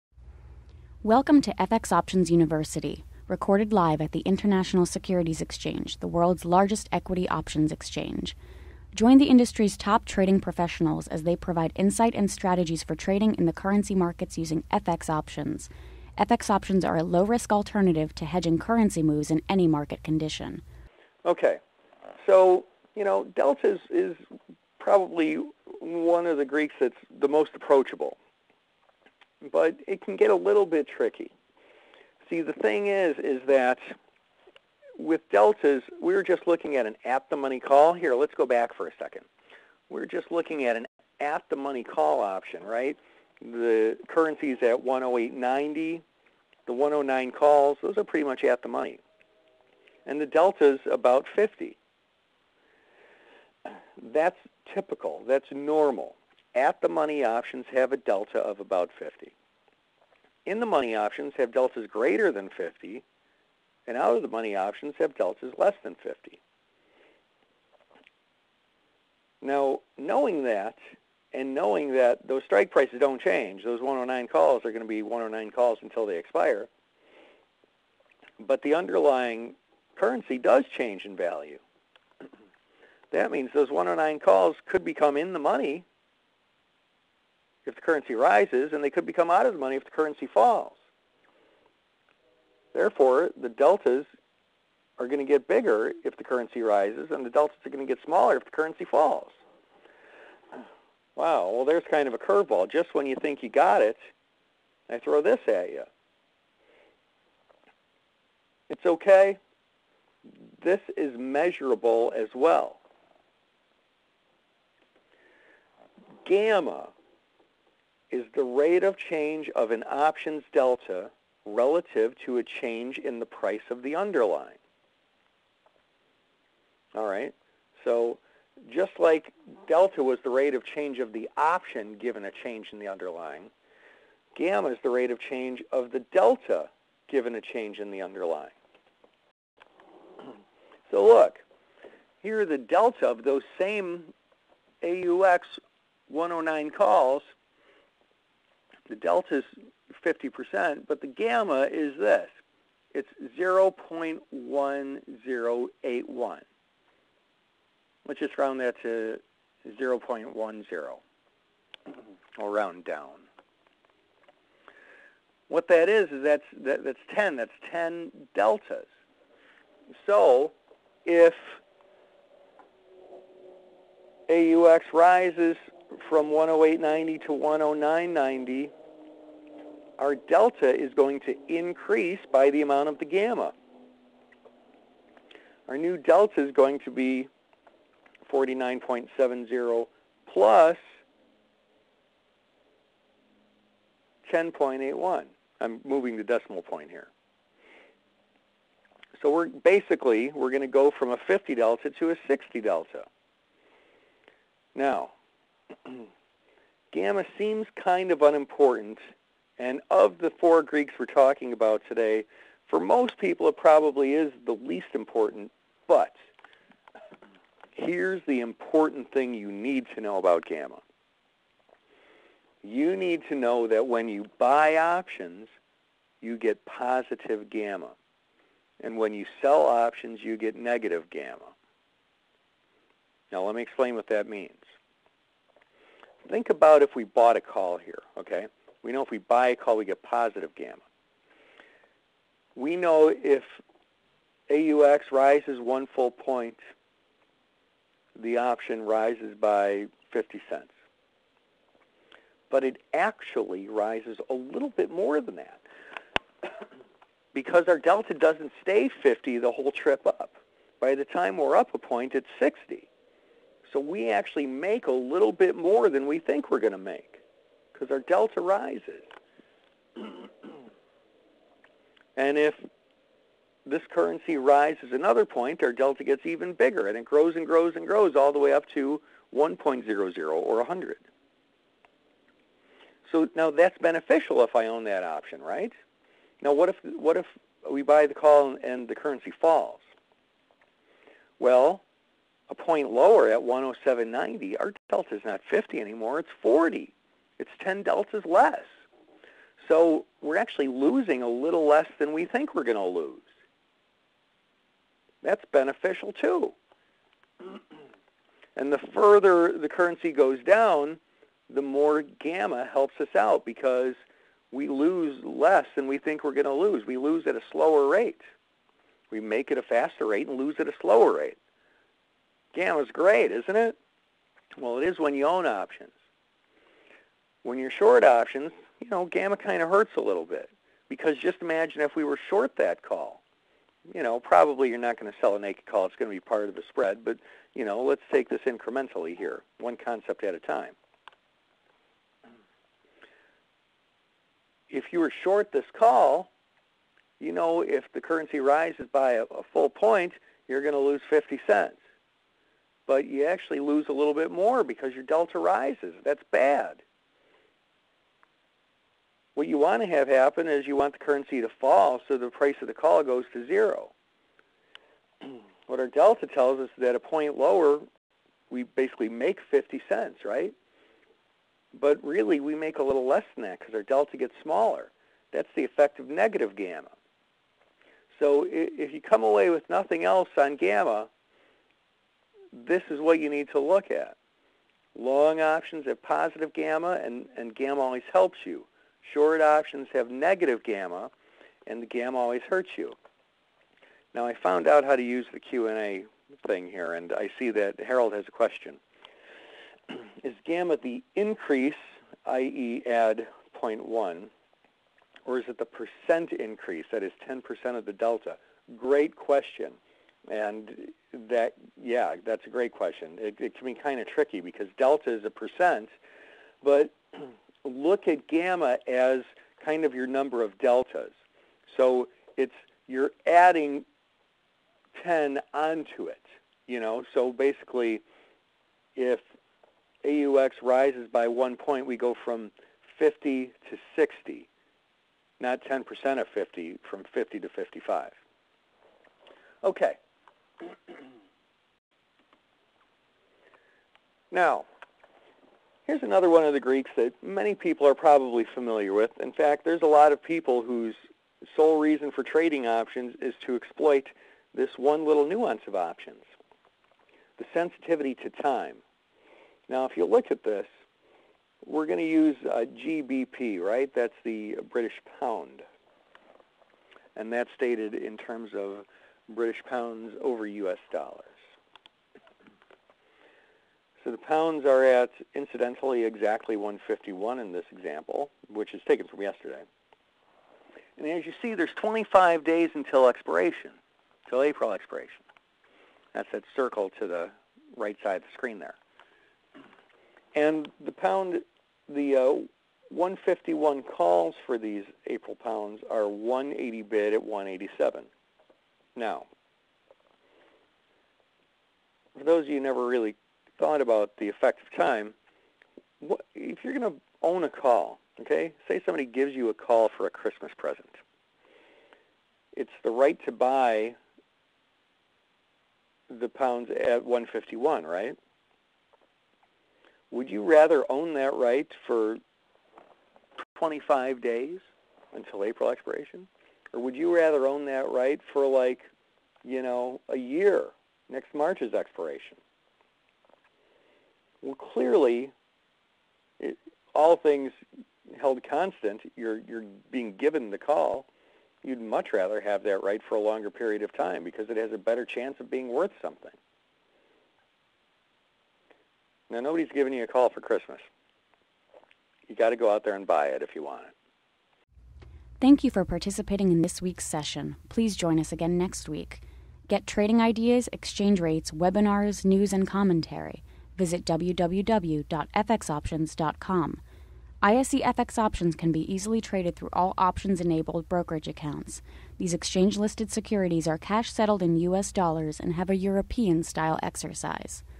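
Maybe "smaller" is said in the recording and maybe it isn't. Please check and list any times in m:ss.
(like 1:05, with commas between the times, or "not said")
1:38, 6:14.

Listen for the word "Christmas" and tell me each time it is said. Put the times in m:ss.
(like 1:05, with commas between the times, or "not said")
8:30, 9:10.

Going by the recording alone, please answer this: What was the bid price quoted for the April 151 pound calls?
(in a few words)
180.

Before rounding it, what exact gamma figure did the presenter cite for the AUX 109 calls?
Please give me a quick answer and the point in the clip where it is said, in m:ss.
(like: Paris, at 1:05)
0.1081, at 2:33.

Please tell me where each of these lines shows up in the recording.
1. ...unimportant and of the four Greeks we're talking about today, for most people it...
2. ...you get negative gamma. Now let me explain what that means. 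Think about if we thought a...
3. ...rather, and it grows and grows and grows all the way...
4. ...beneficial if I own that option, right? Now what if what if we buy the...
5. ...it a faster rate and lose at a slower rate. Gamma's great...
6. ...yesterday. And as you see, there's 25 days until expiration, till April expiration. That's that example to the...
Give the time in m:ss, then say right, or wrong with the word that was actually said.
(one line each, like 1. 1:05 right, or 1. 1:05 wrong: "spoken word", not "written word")
1. 3:28 right
2. 3:50 wrong: "bought", not "thought"
3. 4:36 wrong: "bigger", not "rather"
4. 4:43 right
5. 5:19 right
6. 7:59 wrong: "circle", not "example".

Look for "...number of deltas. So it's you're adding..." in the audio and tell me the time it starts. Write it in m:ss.
7:00.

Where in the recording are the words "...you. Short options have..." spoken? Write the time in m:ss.
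6:28.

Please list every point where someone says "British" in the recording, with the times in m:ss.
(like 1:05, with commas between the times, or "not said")
7:44, 7:49.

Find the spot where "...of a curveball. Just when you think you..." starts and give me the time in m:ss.
1:42.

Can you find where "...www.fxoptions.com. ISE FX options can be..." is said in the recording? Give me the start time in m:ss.
9:24.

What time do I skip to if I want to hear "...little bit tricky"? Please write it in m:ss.
0:30.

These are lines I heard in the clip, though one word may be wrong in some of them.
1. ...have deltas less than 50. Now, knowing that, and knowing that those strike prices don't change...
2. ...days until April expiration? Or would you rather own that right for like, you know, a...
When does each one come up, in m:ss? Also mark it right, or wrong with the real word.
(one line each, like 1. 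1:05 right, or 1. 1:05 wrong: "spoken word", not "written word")
1. 1:04 right
2. 8:44 right.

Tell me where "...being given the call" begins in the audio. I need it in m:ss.
8:59.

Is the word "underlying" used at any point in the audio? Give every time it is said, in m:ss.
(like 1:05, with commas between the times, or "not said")
1:18, 2:03, 2:12, 2:18.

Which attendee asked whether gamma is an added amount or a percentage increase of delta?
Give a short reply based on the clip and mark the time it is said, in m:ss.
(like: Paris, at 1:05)
Harold, at 6:37.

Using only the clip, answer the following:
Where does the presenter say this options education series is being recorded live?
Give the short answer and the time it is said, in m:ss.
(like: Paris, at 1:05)
International Securities Exchange, at 0:04.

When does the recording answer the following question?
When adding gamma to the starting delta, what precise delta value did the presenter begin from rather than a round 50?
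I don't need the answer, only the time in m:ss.
3:08.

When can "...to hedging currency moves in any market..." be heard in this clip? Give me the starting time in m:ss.
0:18.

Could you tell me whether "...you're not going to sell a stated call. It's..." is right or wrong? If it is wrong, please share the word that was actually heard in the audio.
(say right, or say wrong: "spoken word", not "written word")
wrong: "naked", not "stated".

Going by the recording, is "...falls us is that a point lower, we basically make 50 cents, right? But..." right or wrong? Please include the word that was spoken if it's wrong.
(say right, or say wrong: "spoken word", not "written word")
wrong: "tells", not "falls".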